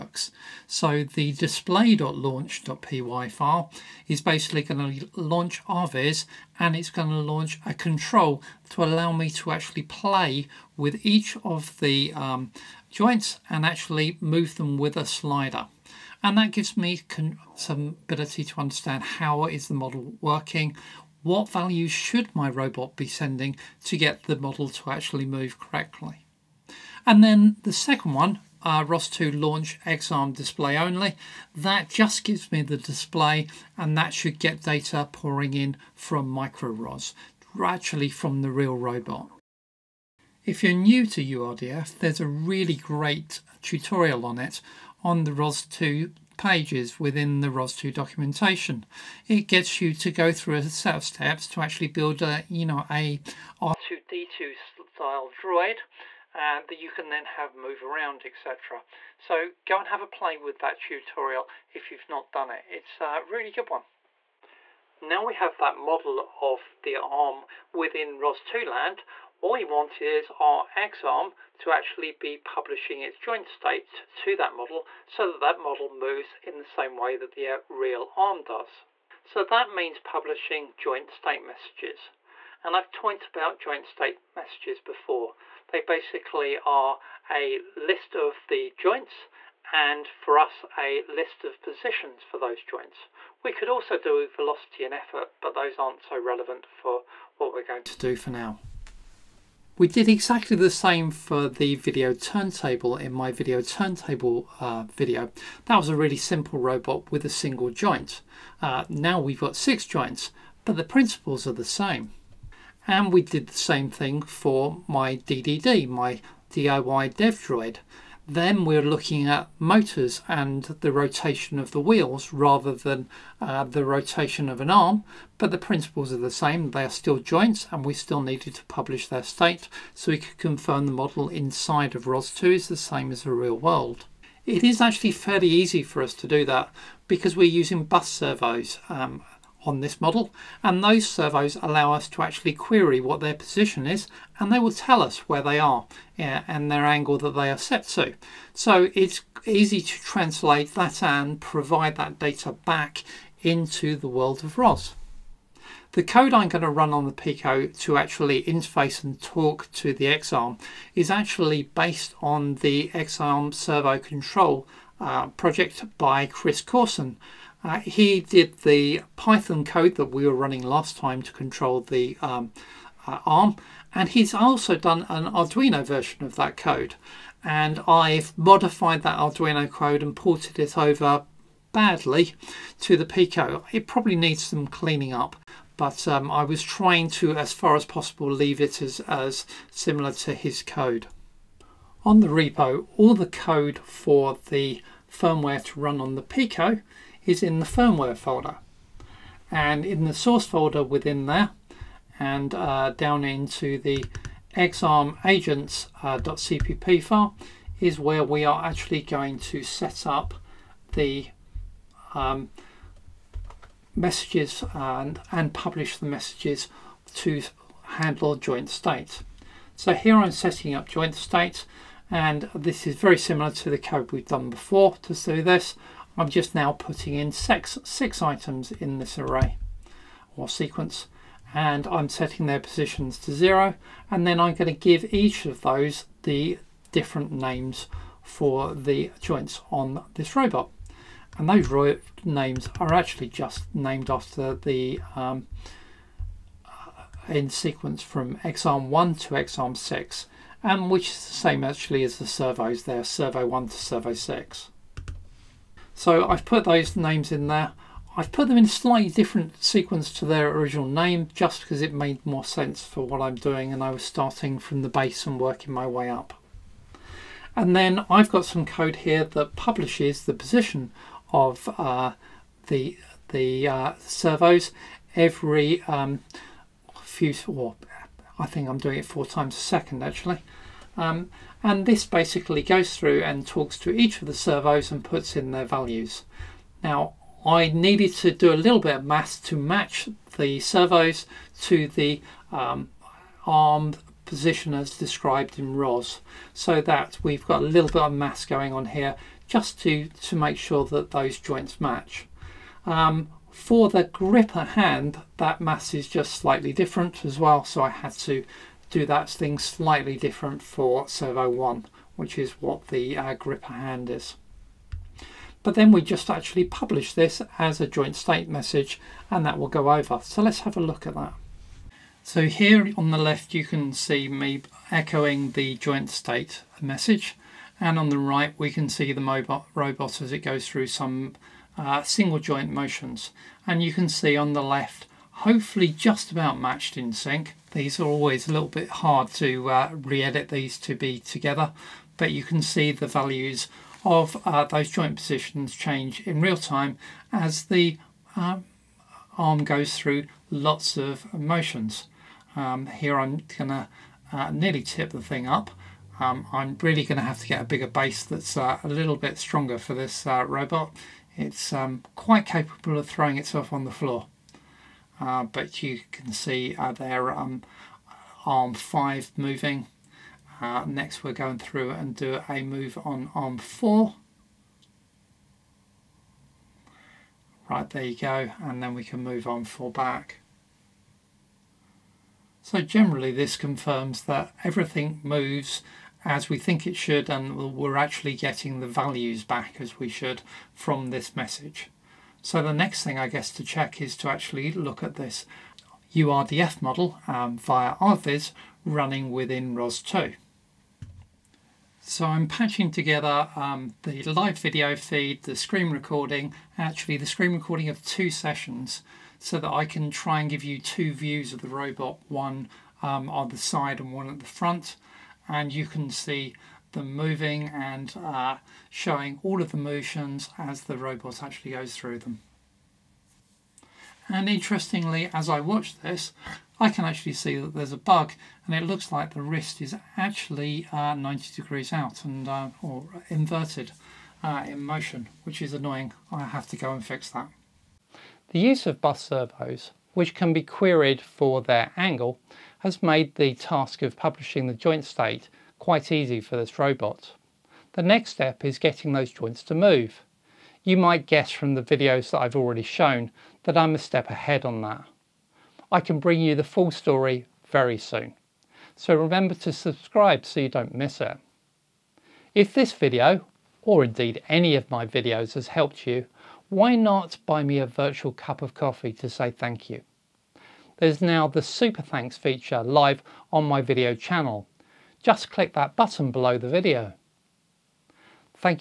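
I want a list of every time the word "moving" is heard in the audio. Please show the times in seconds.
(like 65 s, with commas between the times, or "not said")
369 s, 417 s.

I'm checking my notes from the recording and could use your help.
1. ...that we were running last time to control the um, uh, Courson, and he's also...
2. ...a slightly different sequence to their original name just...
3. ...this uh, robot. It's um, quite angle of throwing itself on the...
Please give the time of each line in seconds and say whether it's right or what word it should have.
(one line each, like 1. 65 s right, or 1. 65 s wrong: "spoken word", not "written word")
1. 169 s wrong: "ARM", not "Courson"
2. 258 s right
3. 359 s wrong: "capable", not "angle".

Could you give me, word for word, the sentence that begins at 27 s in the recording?
And then the second one, uh, ROS2 launch XARM display only.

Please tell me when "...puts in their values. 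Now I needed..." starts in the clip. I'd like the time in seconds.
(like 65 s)
285 s.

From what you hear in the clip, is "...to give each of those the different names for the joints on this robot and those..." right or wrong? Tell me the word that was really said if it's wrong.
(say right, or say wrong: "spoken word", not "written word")
right.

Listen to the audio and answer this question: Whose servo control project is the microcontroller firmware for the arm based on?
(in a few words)
Chris Courson.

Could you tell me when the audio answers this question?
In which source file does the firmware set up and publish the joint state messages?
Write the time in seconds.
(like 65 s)
204 s.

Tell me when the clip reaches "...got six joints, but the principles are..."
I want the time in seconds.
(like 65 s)
109 s.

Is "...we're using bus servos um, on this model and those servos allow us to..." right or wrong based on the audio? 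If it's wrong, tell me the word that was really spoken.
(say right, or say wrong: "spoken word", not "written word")
right.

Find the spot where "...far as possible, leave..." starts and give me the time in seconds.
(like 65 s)
187 s.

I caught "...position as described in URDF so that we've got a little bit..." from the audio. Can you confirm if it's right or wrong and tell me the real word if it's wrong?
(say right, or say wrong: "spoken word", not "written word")
wrong: "ROS", not "URDF".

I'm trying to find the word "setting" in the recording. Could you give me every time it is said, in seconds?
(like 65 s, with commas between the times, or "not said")
220 s, 232 s.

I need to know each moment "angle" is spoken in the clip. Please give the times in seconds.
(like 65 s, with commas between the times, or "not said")
146 s, 441 s.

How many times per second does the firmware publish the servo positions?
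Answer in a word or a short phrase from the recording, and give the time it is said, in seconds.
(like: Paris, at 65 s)
4, at 279 s.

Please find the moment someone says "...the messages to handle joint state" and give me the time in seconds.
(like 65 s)
215 s.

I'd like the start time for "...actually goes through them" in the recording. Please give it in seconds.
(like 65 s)
421 s.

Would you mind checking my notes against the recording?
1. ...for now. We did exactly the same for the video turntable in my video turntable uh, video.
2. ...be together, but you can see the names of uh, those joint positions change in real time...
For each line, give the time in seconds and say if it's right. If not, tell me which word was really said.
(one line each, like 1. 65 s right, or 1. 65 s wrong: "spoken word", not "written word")
1. 98 s right
2. 340 s wrong: "values", not "names".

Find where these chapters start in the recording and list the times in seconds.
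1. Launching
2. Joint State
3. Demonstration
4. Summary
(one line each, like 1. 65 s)
1. 29 s
2. 69 s
3. 329 s
4. 439 s.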